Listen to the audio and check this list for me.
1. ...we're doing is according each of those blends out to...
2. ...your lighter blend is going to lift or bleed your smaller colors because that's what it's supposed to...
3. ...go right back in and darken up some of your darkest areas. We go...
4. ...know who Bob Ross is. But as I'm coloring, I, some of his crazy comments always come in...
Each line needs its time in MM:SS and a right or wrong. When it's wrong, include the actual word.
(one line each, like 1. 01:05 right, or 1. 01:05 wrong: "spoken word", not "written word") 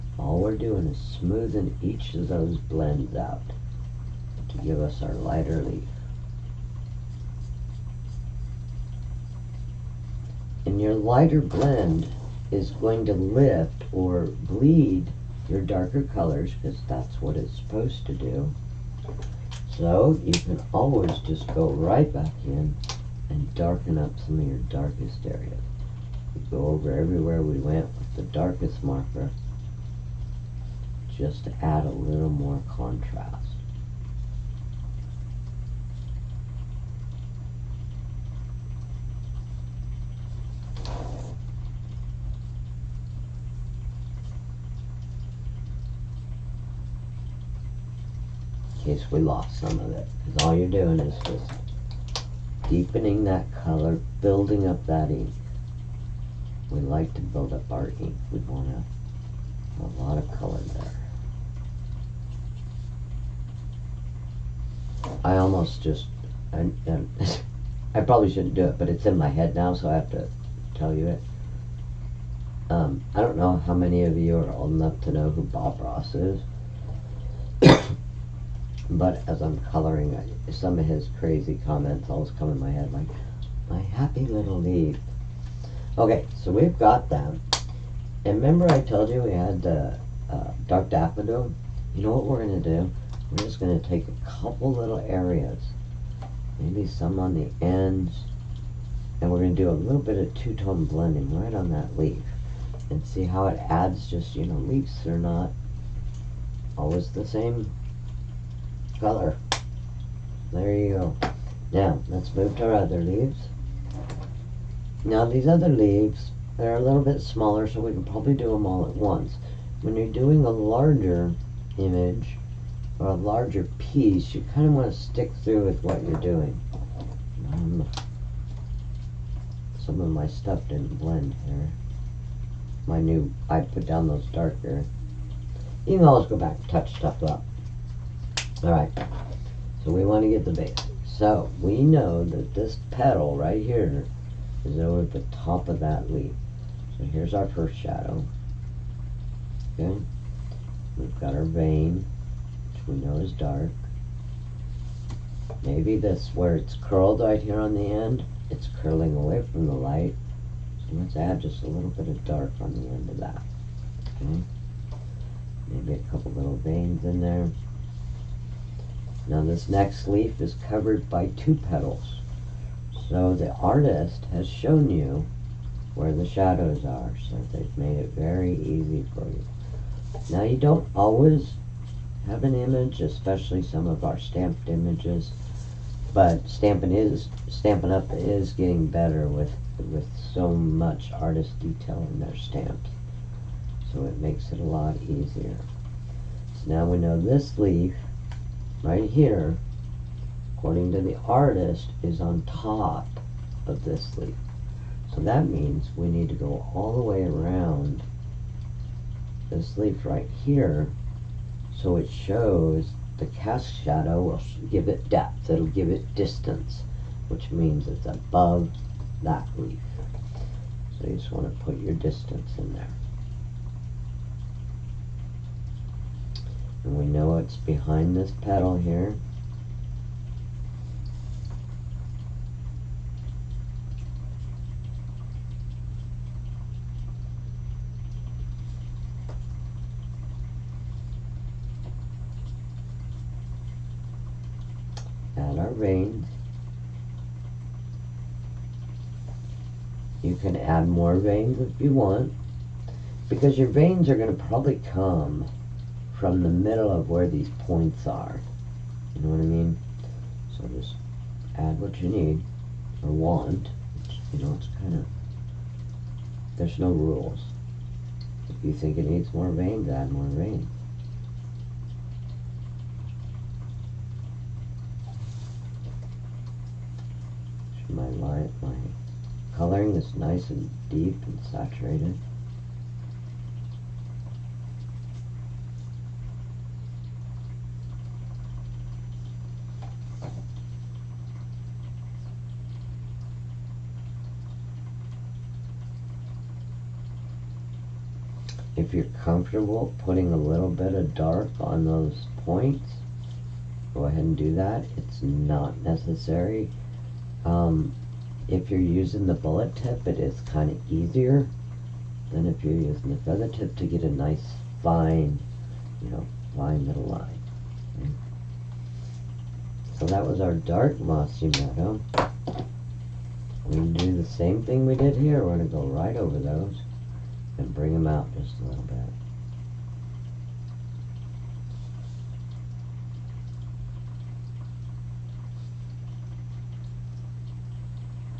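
1. 00:00 wrong: "smoothing", not "according"
2. 00:10 wrong: "darker", not "smaller"
3. 00:21 right
4. 01:15 right.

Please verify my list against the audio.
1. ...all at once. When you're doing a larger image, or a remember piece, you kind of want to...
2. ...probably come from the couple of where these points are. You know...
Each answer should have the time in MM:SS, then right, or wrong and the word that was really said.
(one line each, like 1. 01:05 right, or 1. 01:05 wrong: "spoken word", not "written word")
1. 01:58 wrong: "larger", not "remember"
2. 04:14 wrong: "middle", not "couple".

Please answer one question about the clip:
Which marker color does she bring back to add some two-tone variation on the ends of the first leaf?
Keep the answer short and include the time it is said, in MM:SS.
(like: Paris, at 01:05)
dark daffodil, at 01:30.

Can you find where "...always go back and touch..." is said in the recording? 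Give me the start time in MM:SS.
02:16.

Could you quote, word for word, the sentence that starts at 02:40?
So let's add just a little bit of dark on the end of that.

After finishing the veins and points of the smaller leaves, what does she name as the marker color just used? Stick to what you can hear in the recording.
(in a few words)
dark mossy meadow.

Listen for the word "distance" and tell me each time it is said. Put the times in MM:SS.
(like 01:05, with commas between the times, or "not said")
03:36, 03:41.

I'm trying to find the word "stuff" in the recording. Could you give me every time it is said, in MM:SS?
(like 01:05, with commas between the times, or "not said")
02:10, 02:16.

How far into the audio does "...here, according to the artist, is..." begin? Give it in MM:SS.
03:19.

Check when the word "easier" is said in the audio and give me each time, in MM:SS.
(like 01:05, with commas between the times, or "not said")
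03:15, 05:10.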